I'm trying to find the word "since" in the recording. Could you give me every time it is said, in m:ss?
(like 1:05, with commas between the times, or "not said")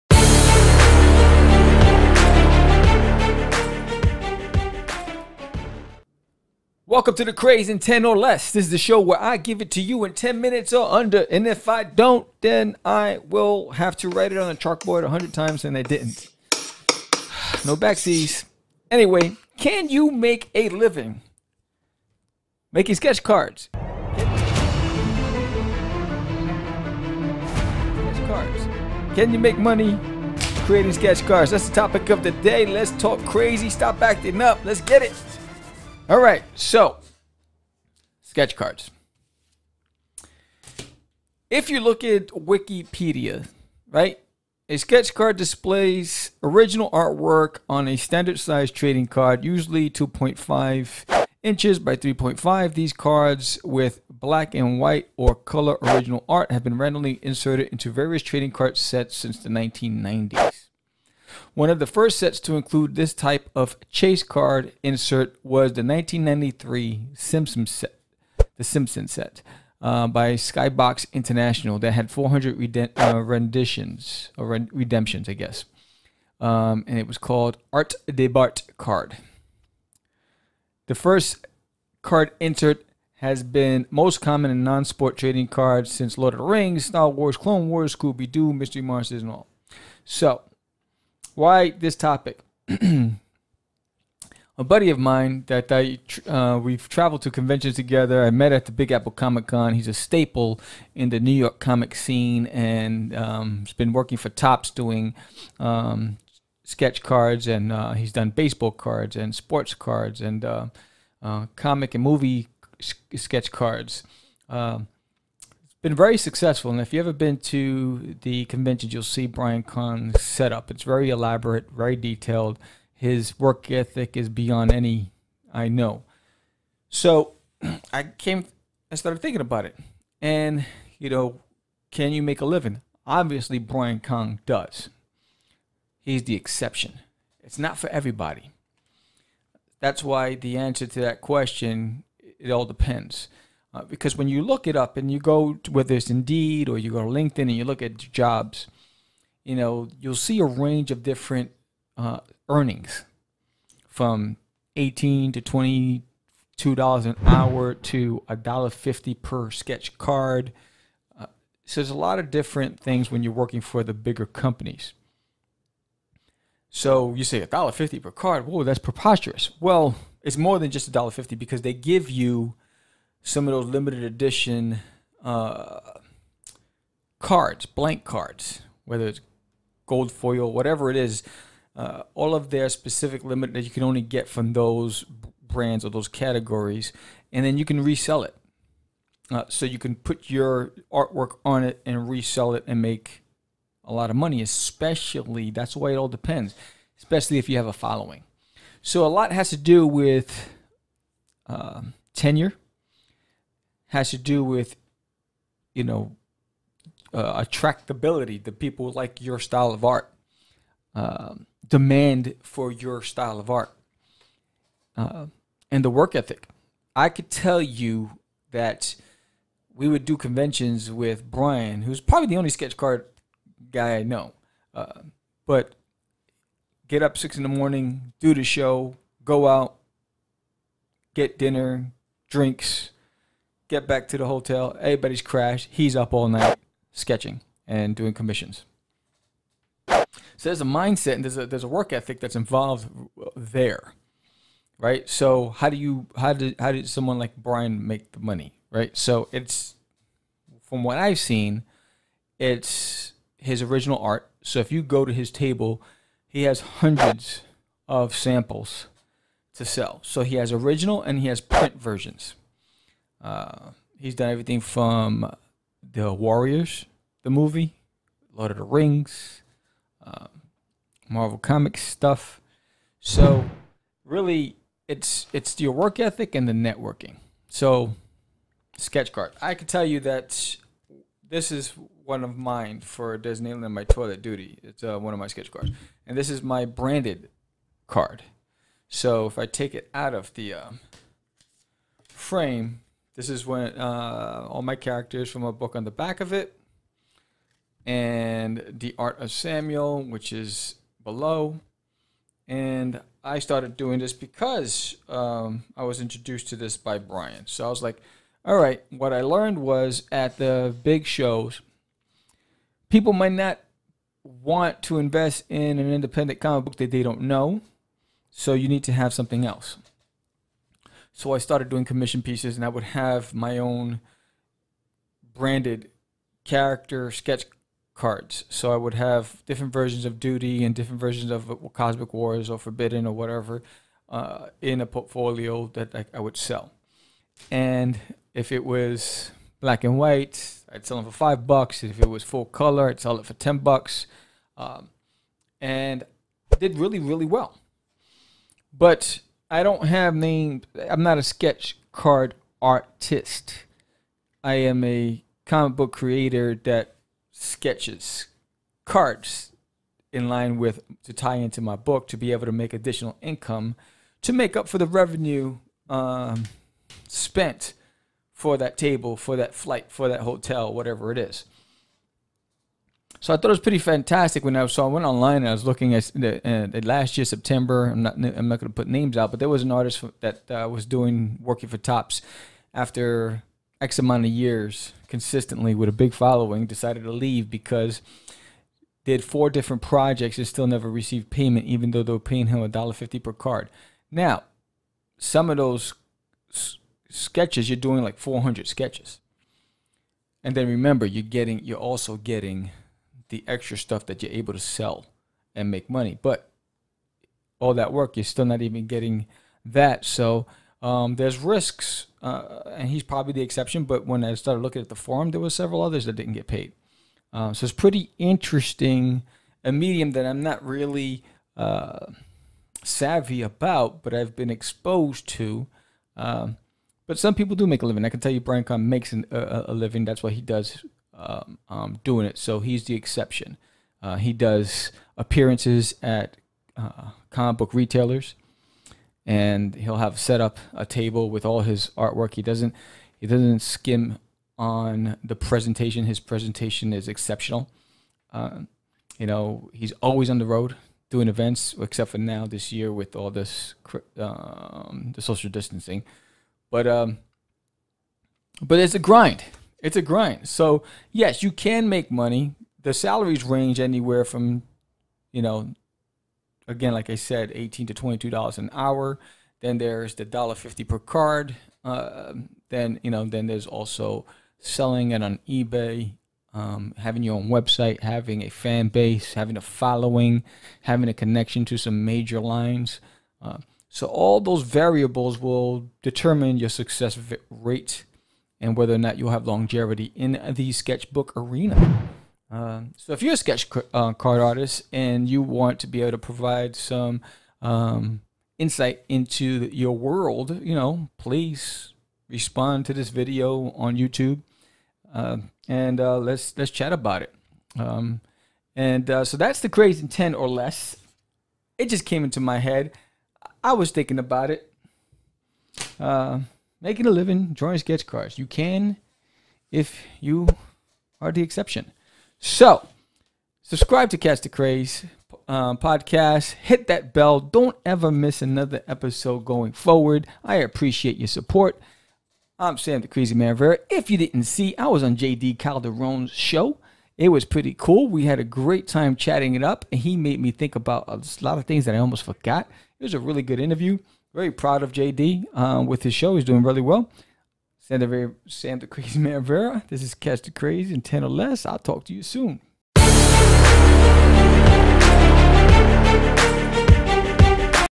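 0:59, 1:25.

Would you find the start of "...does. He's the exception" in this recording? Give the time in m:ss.
2:14.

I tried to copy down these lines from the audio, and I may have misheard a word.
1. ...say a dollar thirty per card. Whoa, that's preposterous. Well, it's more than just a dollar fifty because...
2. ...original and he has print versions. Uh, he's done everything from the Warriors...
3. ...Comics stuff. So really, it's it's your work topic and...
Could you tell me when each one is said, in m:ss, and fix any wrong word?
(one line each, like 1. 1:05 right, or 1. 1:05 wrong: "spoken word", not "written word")
1. 2:47 wrong: "fifty", not "thirty"
2. 4:20 right
3. 4:31 wrong: "ethic", not "topic".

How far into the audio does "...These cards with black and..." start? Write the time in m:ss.
0:52.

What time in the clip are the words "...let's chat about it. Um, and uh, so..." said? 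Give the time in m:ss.
8:26.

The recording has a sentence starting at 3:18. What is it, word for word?
So a lot has to do with uh, tenure has to do with, you know, uh, attractability.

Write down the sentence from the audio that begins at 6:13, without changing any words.
So I thought it was pretty fantastic when I saw.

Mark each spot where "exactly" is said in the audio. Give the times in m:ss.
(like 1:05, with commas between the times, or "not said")
not said.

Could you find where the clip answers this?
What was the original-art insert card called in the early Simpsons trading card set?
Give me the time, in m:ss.
1:17.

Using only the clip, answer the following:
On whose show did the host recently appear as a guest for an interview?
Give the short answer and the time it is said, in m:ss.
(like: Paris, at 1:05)
JD Calderon, at 8:55.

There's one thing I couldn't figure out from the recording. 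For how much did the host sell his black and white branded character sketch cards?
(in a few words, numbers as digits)
$5.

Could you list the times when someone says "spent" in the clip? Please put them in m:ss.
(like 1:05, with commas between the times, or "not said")
6:07.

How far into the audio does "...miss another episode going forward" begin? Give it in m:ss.
8:48.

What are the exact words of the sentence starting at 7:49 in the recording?
Then there's the dollar fifty per card.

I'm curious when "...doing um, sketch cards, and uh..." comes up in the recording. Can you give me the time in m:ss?
1:44.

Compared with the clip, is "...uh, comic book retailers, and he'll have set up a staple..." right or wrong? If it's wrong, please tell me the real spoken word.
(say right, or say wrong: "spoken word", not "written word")
wrong: "table", not "staple".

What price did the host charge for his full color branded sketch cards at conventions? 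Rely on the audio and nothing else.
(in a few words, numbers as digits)
$10.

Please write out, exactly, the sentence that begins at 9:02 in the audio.
It was a really good interview very proud of JD um, uh, with his show.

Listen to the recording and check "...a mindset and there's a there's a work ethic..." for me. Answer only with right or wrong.
right.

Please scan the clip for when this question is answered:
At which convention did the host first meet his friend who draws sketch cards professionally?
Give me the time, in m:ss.
1:38.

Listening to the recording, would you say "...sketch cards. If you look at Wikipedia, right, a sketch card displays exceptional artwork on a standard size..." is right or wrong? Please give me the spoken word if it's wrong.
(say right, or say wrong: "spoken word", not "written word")
wrong: "original", not "exceptional".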